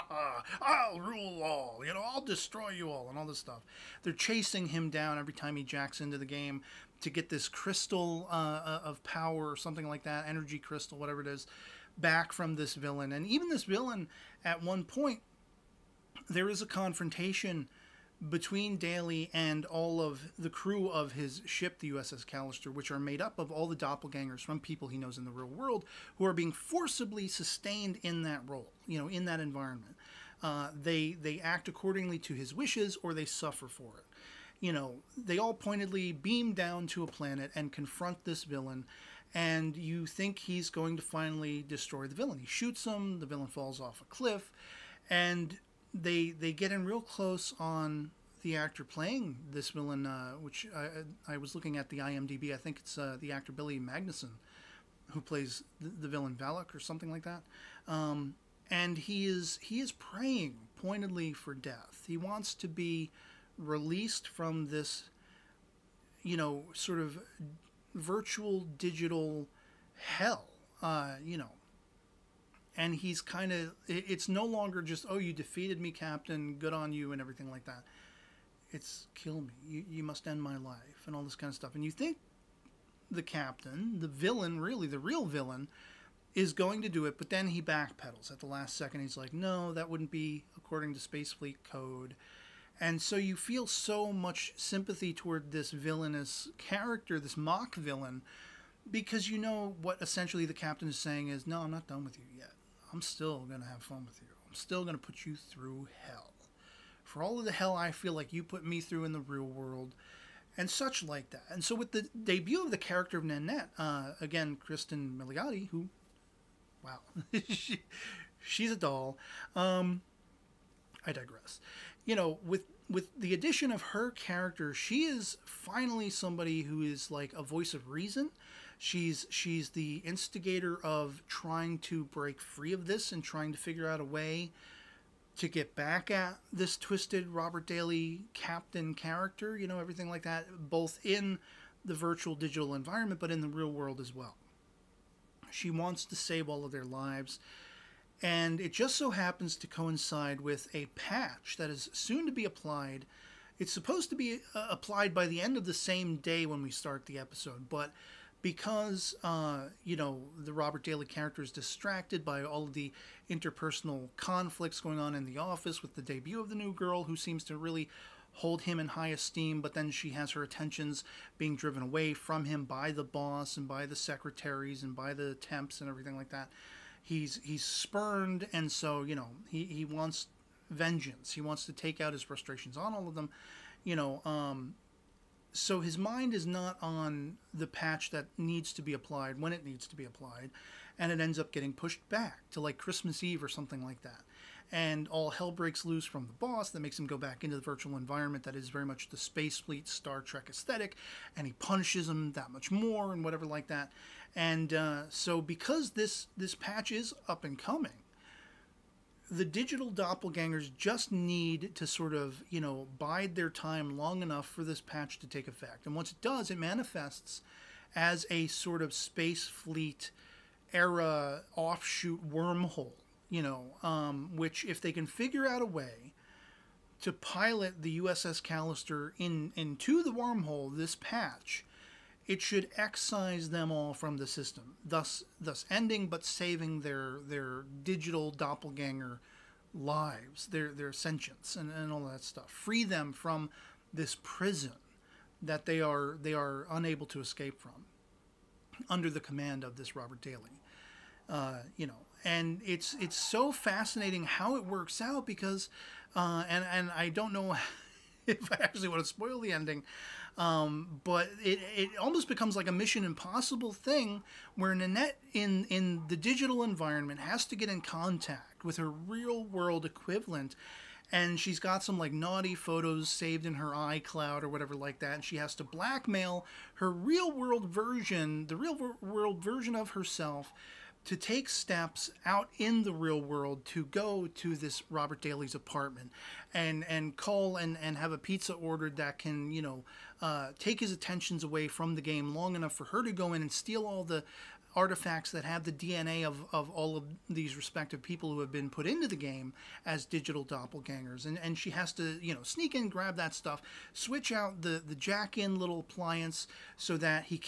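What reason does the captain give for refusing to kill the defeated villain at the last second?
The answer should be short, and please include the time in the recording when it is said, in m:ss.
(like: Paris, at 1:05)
Space Fleet code, at 1:30.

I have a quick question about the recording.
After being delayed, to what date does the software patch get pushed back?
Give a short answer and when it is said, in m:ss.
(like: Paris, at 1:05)
Christmas Eve, at 3:12.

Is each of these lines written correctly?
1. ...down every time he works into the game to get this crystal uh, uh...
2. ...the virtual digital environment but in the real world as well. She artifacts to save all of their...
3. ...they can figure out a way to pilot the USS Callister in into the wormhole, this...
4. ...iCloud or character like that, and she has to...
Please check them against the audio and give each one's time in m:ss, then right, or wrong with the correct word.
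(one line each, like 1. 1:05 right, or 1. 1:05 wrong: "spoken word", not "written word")
1. 0:04 wrong: "jacks", not "works"
2. 2:21 wrong: "wants", not "artifacts"
3. 3:44 right
4. 4:33 wrong: "whatever", not "character".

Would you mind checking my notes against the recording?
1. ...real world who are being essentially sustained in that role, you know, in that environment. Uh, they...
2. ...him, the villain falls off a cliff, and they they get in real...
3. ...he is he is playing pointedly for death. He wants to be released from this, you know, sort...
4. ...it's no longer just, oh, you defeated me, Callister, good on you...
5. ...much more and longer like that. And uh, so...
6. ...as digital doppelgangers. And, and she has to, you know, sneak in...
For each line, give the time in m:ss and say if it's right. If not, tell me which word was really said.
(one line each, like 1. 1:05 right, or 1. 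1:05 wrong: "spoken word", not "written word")
1. 0:25 wrong: "forcibly", not "essentially"
2. 0:42 right
3. 0:58 wrong: "praying", not "playing"
4. 1:14 wrong: "Captain", not "Callister"
5. 3:22 wrong: "whatever", not "longer"
6. 4:59 right.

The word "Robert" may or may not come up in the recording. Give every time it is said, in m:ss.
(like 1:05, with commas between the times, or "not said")
2:17, 2:40, 4:09, 4:44.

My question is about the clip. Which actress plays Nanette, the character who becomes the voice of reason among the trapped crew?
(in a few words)
Cristin Milioti.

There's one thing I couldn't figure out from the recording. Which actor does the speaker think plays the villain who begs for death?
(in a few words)
Billy Magnussen.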